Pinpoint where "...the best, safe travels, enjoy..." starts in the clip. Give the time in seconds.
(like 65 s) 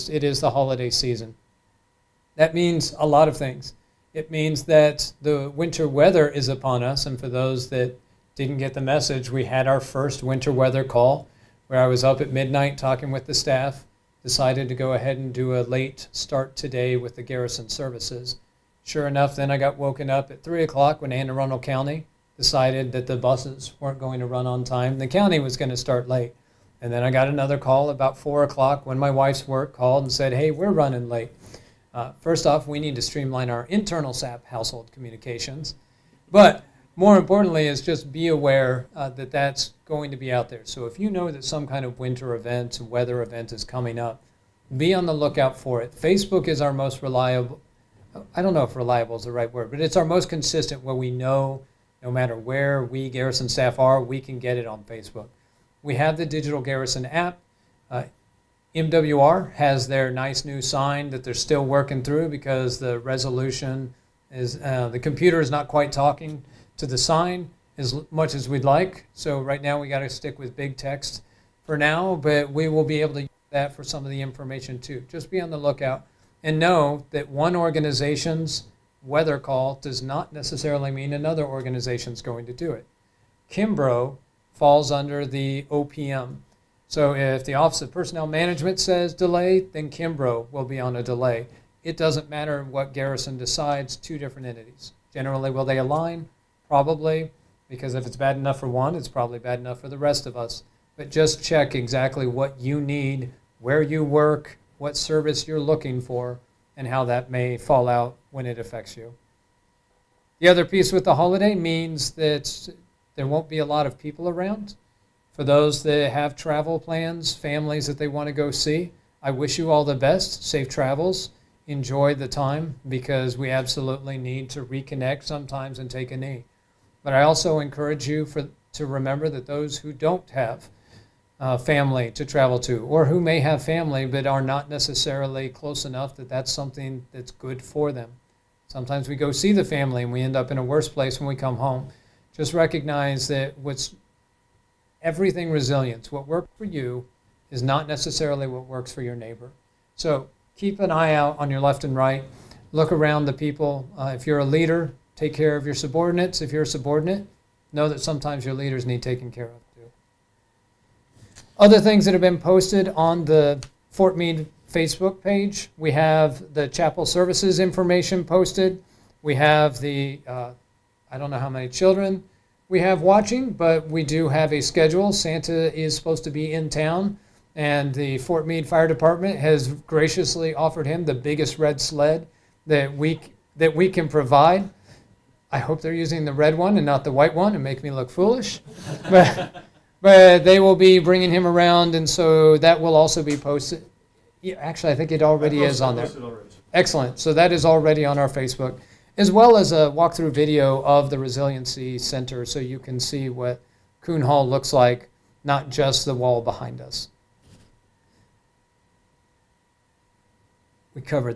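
119 s.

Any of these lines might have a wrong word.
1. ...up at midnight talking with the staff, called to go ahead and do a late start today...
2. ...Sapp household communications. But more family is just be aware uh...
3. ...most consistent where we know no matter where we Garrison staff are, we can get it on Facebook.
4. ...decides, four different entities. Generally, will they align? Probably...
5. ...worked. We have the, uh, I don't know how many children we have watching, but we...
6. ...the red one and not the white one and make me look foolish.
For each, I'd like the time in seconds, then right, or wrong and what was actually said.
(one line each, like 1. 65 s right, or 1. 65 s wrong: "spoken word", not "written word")
1. 12 s wrong: "decided", not "called"
2. 34 s wrong: "importantly", not "family"
3. 50 s right
4. 93 s wrong: "two", not "four"
5. 168 s wrong: "posted", not "worked"
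6. 186 s right.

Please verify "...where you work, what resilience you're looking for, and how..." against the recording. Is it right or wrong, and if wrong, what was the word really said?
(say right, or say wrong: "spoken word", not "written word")
wrong: "service", not "resilience".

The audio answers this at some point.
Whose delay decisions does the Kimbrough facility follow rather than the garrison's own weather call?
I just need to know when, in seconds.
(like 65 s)
87 s.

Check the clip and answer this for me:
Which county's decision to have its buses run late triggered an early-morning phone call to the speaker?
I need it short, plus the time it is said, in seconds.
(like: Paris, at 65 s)
Anne Arundel County, at 21 s.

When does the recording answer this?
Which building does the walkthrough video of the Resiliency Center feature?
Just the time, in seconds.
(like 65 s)
204 s.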